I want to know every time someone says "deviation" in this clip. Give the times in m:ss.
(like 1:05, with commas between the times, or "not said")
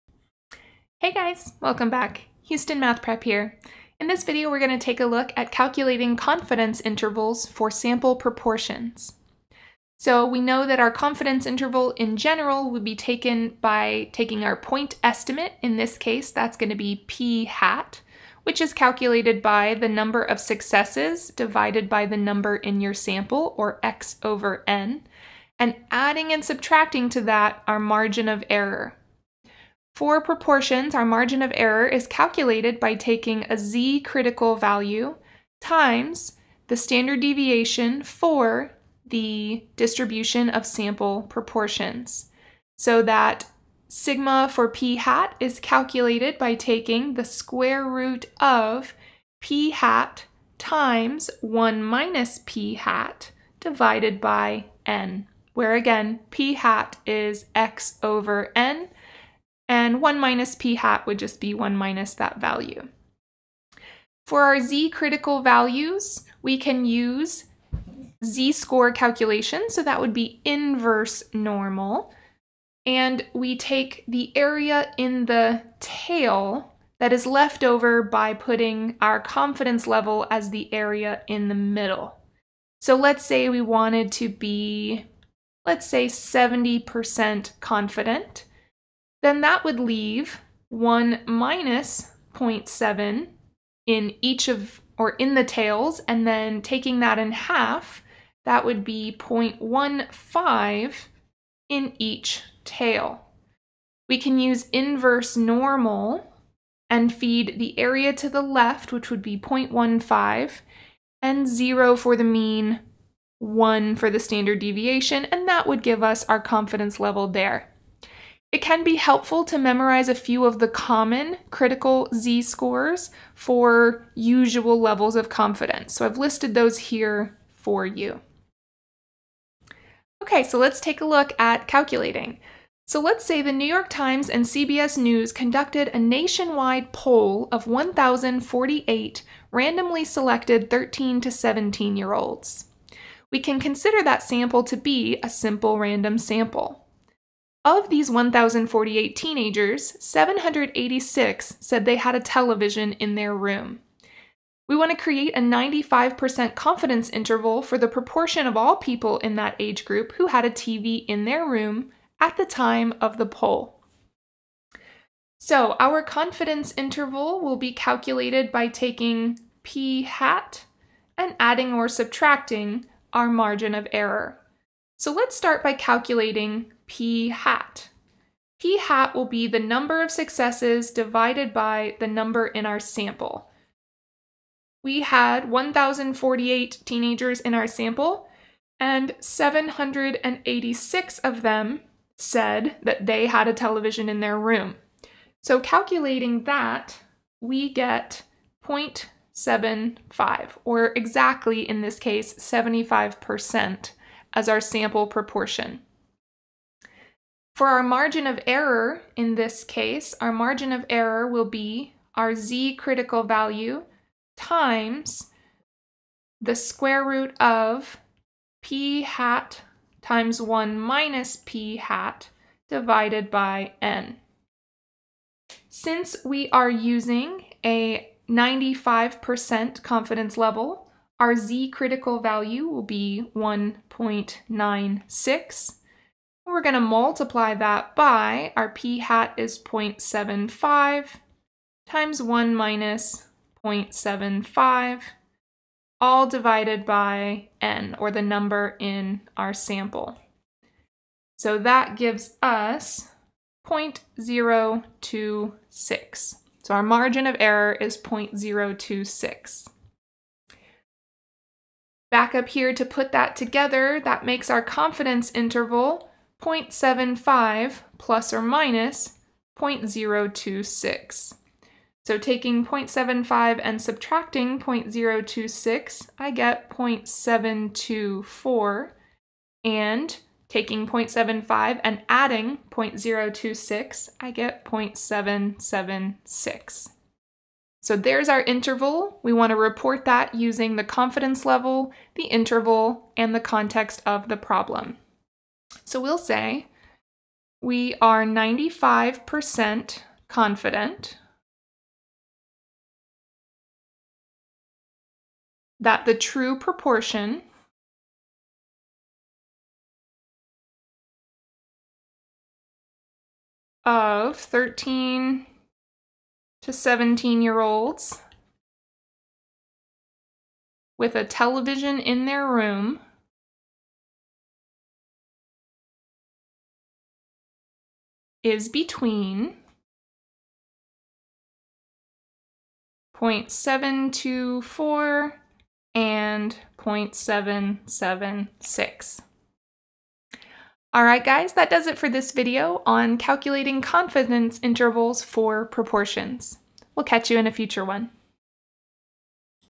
0:37, 1:54.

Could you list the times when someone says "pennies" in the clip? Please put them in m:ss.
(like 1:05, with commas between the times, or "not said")
not said.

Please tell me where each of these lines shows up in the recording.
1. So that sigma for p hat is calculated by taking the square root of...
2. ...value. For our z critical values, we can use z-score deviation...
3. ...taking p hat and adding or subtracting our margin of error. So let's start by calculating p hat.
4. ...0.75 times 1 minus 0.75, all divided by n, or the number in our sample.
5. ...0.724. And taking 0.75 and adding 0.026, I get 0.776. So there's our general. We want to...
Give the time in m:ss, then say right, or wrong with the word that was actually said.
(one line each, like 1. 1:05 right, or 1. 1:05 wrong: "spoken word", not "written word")
1. 0:42 right
2. 1:02 wrong: "calculation", not "deviation"
3. 2:48 right
4. 3:59 right
5. 4:36 wrong: "interval", not "general".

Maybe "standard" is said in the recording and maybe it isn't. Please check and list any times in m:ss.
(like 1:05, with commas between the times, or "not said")
0:36, 1:54.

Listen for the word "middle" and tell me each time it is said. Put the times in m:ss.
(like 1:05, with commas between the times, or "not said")
1:21.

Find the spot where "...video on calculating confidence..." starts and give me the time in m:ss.
5:42.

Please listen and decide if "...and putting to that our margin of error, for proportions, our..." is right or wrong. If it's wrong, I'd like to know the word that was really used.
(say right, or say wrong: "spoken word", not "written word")
wrong: "subtracting", not "putting".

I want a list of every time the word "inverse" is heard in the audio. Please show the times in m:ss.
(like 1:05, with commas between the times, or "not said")
1:10, 1:44.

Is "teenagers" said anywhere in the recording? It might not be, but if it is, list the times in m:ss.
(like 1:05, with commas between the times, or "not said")
2:29, 3:06.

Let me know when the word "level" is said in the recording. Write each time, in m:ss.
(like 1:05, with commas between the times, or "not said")
1:19, 1:56, 2:04, 3:50, 4:51.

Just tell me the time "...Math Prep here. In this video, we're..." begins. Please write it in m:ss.
0:02.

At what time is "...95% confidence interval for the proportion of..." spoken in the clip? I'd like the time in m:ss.
2:35.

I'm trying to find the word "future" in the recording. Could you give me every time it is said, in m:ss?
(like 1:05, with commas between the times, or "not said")
5:47.